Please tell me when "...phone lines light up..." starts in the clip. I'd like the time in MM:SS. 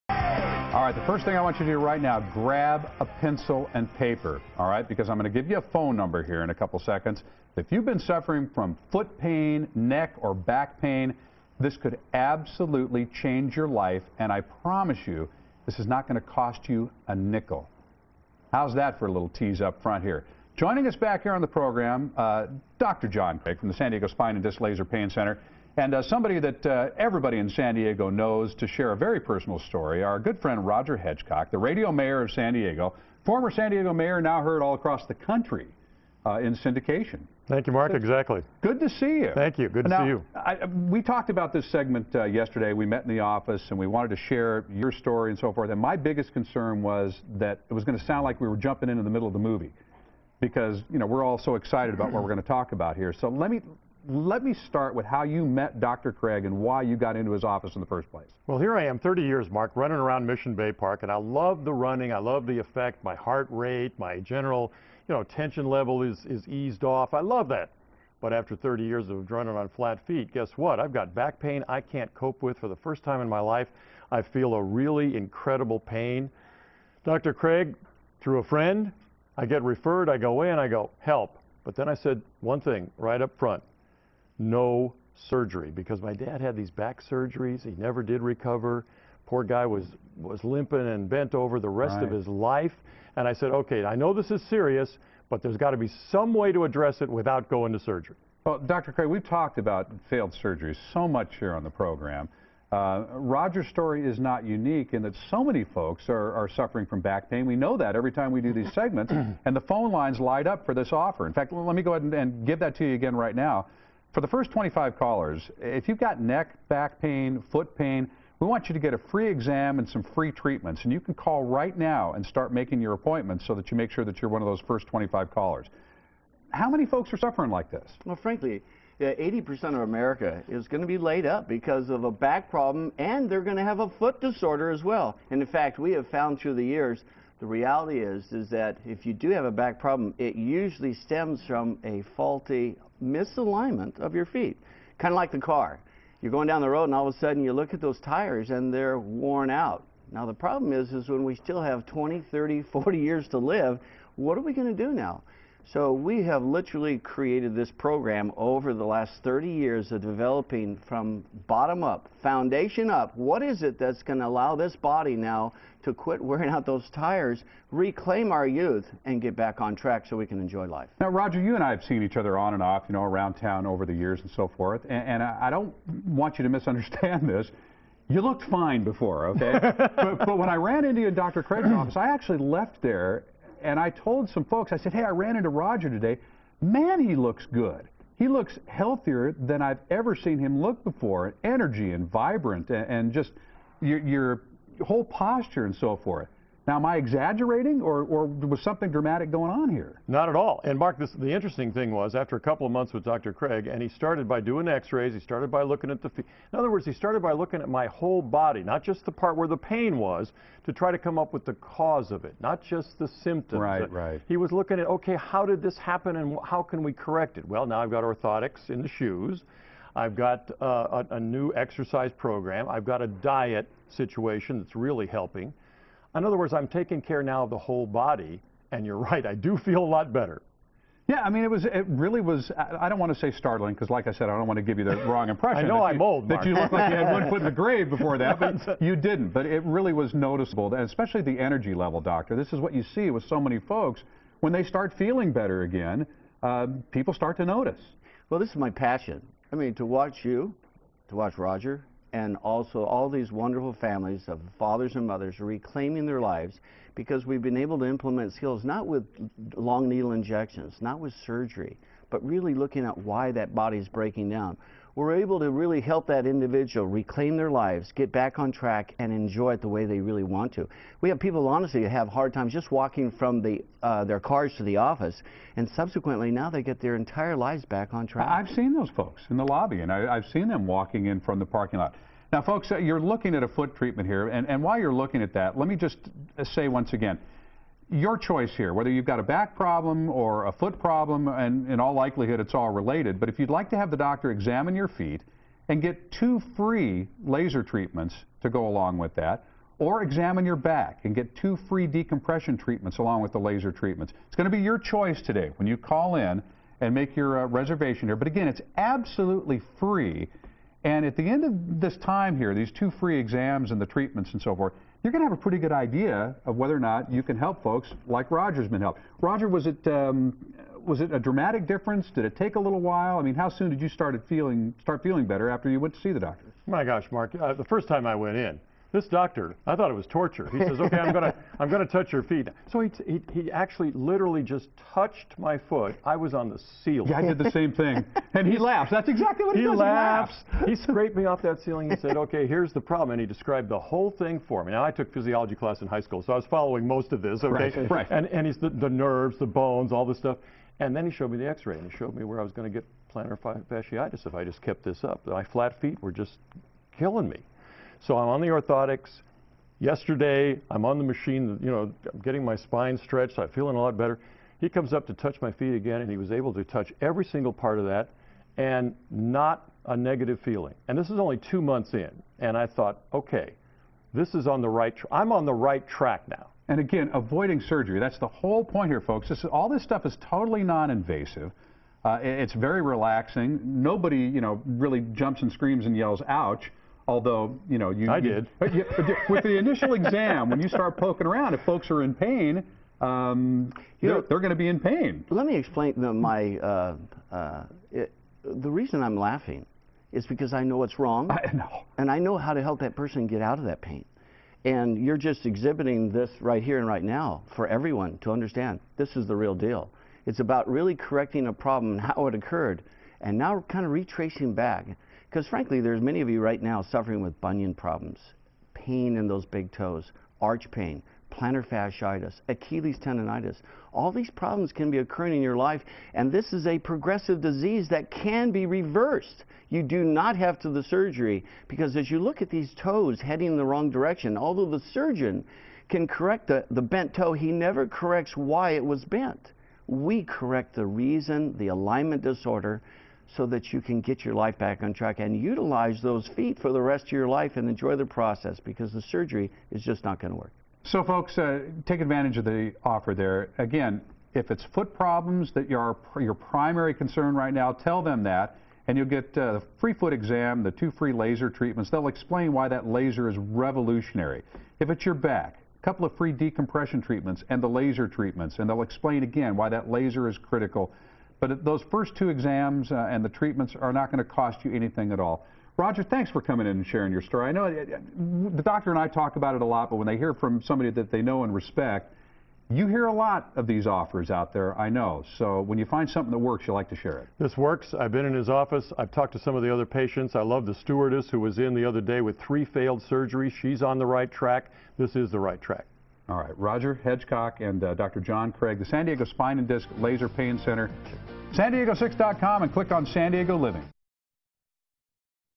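01:49.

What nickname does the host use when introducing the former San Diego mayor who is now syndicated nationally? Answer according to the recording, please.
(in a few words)
The radio mayor.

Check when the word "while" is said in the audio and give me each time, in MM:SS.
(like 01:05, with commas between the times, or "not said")
04:44, 05:22.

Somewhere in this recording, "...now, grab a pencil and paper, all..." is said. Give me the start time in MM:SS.
00:02.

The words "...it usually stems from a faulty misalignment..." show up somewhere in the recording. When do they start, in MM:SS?
02:20.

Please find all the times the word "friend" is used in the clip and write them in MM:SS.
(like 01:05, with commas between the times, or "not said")
00:30, 01:18.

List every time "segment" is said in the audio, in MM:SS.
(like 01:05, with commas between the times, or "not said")
00:41, 01:48.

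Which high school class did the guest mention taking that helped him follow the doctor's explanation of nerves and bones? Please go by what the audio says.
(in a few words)
Physiology.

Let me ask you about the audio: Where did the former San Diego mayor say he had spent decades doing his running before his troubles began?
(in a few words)
Mission Bay Park.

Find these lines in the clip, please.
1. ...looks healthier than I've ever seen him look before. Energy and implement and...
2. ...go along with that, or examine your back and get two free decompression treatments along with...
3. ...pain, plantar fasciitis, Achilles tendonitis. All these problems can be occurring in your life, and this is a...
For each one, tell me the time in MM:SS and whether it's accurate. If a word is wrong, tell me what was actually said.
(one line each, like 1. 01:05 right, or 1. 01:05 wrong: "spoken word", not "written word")
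1. 03:08 wrong: "vibrant", not "implement"
2. 04:58 right
3. 07:00 right.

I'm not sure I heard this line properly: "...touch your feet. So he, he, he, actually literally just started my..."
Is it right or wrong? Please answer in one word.
wrong.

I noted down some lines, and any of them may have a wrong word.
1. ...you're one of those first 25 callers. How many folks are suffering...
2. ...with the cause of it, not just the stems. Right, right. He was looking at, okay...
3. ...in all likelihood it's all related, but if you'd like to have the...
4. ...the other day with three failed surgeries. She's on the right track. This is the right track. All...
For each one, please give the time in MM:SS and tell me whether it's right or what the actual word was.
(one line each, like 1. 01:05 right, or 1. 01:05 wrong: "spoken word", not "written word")
1. 02:04 right
2. 03:31 wrong: "symptoms", not "stems"
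3. 04:51 right
4. 08:11 right.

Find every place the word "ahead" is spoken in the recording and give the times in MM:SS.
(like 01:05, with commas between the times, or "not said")
01:51.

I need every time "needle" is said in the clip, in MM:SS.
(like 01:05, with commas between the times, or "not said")
04:19.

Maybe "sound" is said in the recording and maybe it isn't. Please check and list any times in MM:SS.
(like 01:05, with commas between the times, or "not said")
00:48.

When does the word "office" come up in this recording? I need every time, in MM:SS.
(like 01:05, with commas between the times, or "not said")
00:43, 00:57, 03:01, 04:34, 08:08.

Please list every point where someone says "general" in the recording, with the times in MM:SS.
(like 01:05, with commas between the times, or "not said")
01:04.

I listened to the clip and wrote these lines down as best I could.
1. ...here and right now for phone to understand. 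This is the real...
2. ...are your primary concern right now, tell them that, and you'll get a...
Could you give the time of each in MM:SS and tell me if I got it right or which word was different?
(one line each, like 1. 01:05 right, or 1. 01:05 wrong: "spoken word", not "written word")
1. 06:46 wrong: "everyone", not "phone"
2. 07:35 right.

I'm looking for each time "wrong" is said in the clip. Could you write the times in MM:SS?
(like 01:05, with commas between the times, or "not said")
03:55, 06:40, 07:13.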